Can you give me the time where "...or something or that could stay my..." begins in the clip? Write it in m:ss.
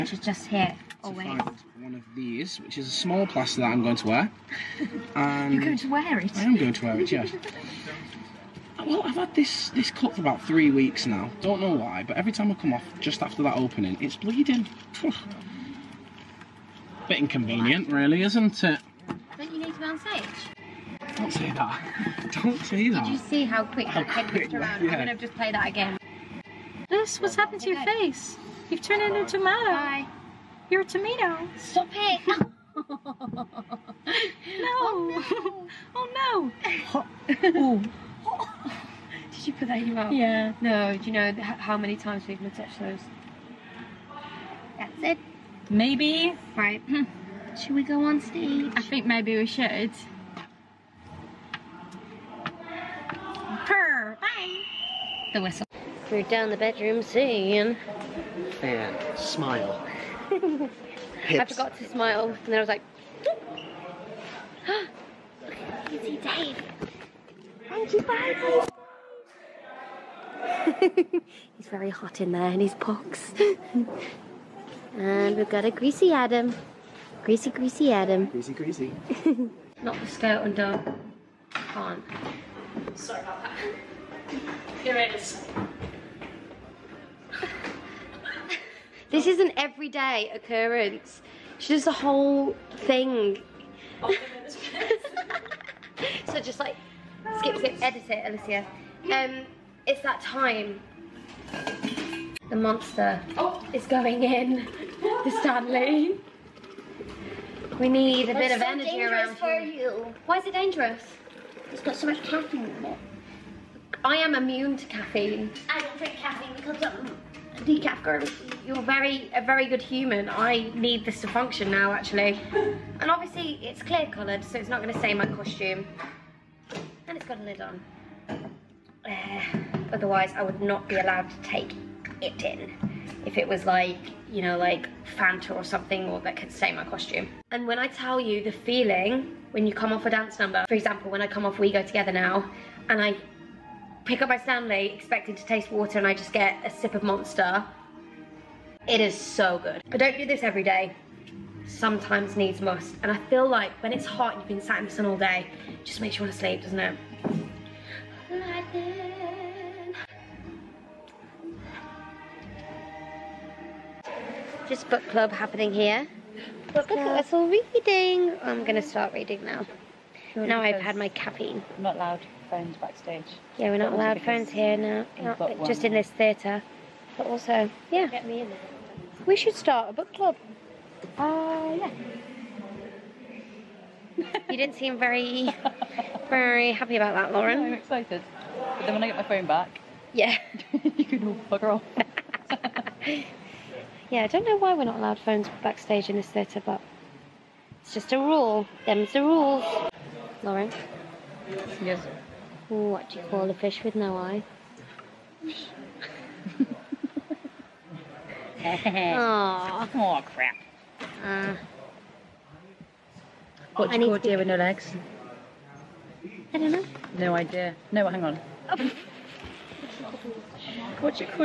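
2:15.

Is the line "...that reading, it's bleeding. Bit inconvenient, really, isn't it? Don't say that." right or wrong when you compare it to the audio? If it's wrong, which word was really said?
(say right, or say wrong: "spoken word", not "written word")
wrong: "opening", not "reading".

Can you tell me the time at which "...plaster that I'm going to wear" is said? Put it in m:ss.
0:03.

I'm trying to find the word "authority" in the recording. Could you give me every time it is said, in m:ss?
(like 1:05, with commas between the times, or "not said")
not said.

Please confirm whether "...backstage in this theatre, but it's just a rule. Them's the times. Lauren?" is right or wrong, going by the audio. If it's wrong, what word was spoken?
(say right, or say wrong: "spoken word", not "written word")
wrong: "rules", not "times".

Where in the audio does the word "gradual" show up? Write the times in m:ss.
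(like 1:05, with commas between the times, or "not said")
not said.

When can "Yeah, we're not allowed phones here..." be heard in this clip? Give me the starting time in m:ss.
2:53.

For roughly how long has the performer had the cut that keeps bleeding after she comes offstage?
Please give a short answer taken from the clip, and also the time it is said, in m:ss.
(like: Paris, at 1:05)
3 weeks, at 0:10.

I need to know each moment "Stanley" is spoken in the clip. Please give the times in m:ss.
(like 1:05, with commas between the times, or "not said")
1:45, 2:24.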